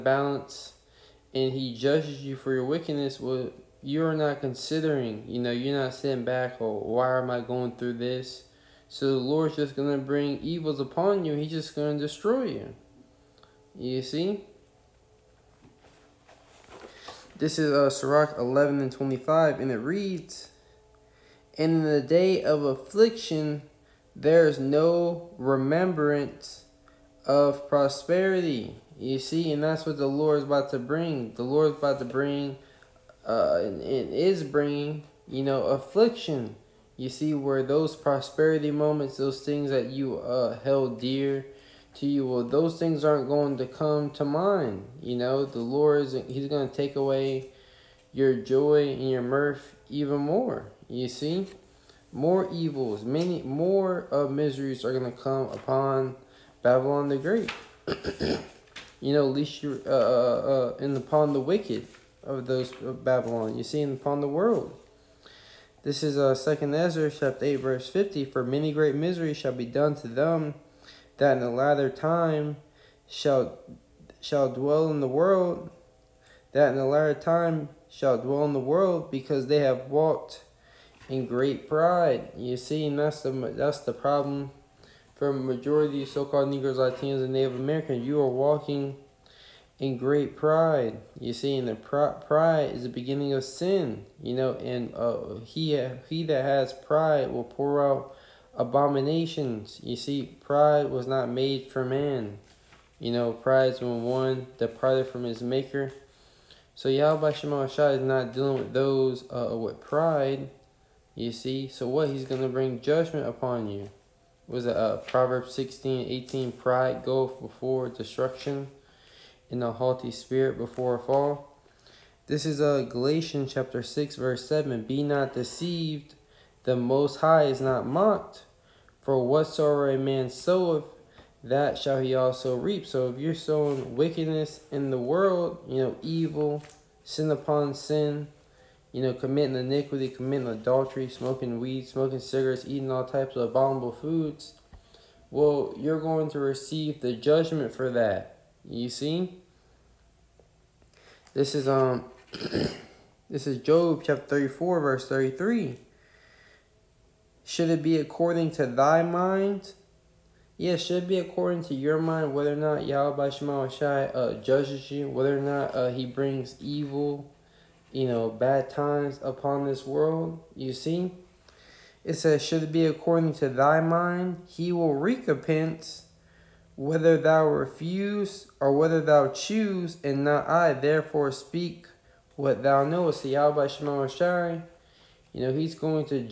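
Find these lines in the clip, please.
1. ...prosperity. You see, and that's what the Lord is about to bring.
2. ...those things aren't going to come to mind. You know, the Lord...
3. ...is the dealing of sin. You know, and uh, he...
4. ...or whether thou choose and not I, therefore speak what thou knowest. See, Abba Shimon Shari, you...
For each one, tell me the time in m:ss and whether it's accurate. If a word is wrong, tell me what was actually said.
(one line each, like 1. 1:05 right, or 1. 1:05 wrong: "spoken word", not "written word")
1. 0:27 right
2. 0:42 right
3. 1:32 wrong: "beginning", not "dealing"
4. 2:58 right.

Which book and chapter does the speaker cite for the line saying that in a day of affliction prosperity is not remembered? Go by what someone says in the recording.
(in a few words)
Sirach 11.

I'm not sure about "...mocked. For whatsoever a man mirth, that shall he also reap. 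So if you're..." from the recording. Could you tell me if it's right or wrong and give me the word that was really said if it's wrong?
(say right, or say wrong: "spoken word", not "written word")
wrong: "soweth", not "mirth".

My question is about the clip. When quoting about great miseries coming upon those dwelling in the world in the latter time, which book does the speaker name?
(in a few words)
Second Ezra.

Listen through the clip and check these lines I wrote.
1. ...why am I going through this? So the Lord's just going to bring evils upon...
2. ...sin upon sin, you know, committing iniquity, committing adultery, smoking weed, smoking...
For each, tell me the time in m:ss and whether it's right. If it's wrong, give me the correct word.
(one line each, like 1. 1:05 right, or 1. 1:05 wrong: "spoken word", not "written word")
1. 0:06 right
2. 2:17 right.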